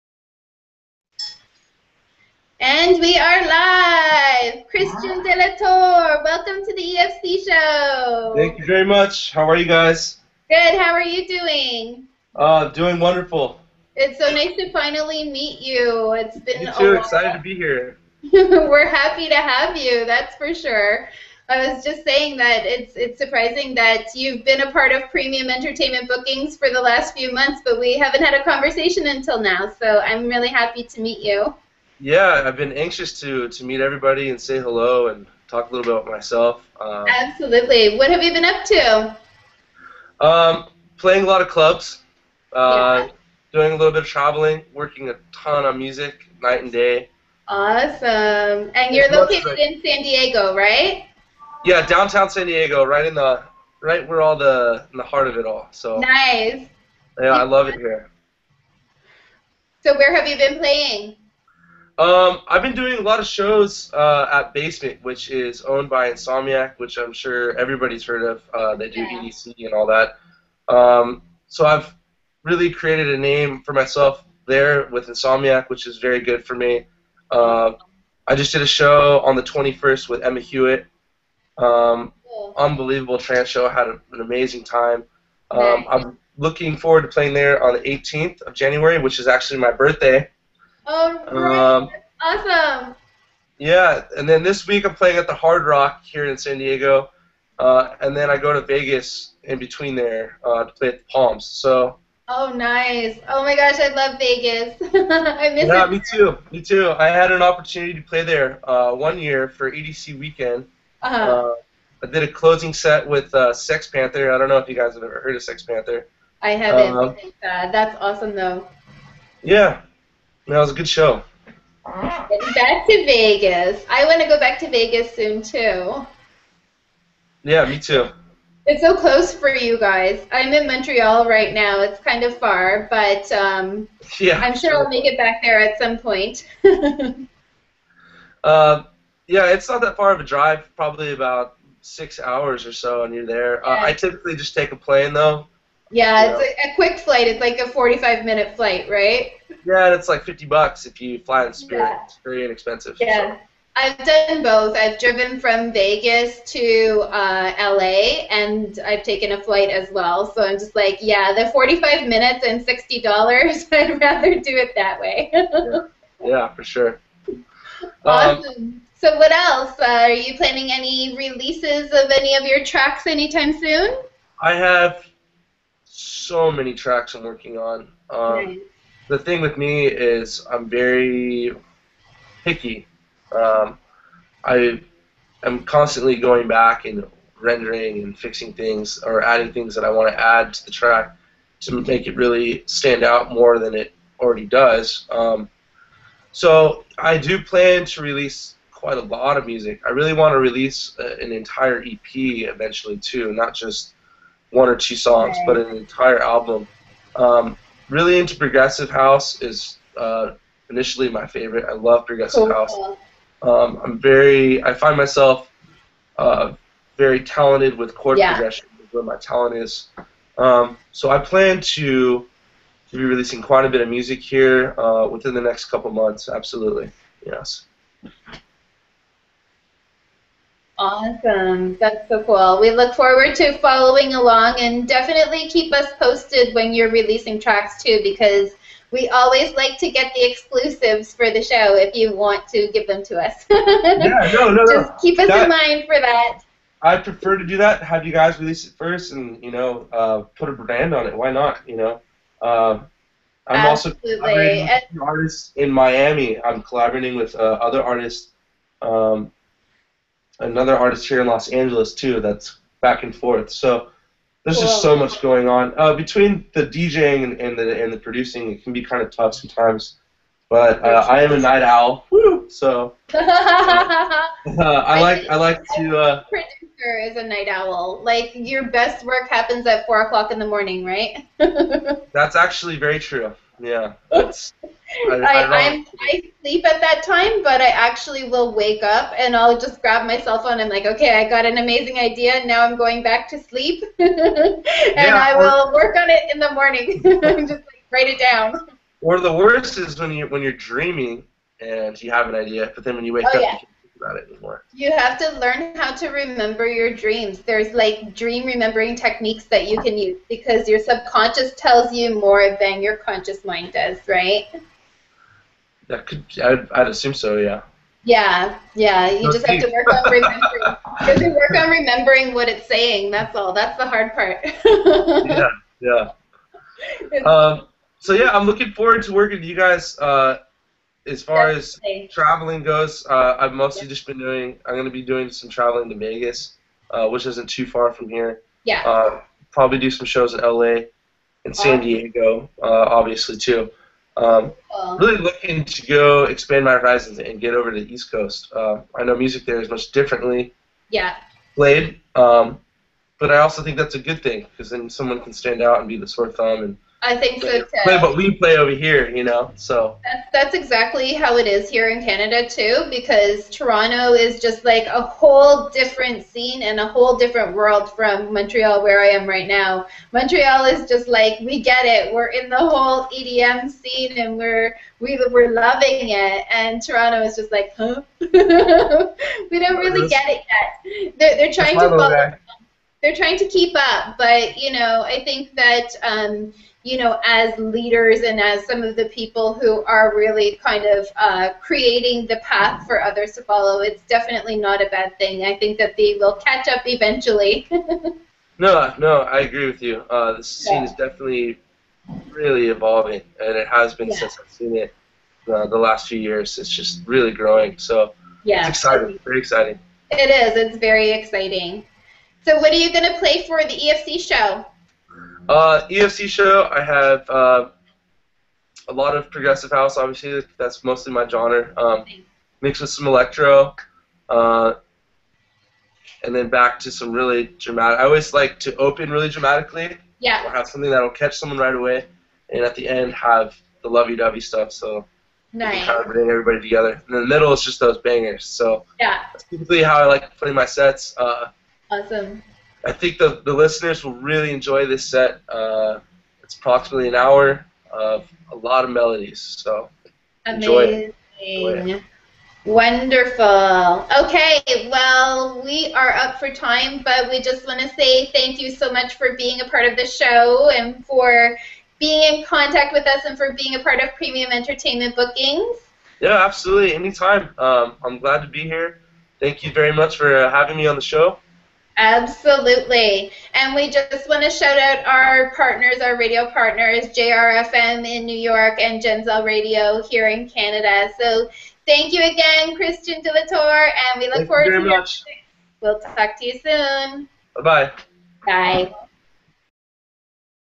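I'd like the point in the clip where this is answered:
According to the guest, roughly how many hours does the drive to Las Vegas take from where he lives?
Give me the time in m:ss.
2:21.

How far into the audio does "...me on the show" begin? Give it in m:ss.
7:50.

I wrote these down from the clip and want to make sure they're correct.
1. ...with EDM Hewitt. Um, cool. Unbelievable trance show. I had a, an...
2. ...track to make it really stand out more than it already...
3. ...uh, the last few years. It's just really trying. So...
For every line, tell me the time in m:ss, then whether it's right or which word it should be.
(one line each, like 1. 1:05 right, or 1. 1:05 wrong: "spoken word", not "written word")
1. 1:20 wrong: "Emma", not "EDM"
2. 3:10 right
3. 6:45 wrong: "growing", not "trying".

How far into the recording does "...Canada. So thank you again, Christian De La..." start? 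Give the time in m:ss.
8:00.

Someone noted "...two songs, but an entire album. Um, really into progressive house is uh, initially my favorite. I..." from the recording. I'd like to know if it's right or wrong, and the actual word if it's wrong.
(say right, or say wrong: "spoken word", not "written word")
right.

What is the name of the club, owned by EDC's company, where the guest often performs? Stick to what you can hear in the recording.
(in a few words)
Basement.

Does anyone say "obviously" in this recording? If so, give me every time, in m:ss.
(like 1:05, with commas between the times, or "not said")
5:42, 6:59.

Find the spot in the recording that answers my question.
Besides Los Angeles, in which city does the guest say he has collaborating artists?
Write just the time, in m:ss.
4:15.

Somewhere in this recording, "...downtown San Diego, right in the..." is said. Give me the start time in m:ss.
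0:51.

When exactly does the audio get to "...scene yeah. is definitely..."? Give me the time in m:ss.
6:40.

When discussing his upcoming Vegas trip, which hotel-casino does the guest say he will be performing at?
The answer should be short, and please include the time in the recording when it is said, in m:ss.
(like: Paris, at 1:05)
the Palms, at 1:40.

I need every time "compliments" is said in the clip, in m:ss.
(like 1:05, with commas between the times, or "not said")
not said.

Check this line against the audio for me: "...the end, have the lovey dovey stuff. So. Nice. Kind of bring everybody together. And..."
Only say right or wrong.
right.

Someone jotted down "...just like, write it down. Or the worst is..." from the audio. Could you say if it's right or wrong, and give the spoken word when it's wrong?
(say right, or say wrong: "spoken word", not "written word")
right.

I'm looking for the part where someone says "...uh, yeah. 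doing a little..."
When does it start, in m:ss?
0:42.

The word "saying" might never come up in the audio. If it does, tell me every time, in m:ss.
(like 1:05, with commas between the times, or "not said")
0:22, 5:22.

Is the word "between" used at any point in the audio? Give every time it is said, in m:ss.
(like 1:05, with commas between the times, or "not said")
1:39, 4:25.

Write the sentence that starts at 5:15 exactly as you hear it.
That could, I'd, I'd assume so, yeah.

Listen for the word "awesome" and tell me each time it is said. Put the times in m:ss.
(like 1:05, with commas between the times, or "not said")
0:47, 1:32, 1:58, 2:48, 3:50, 7:21.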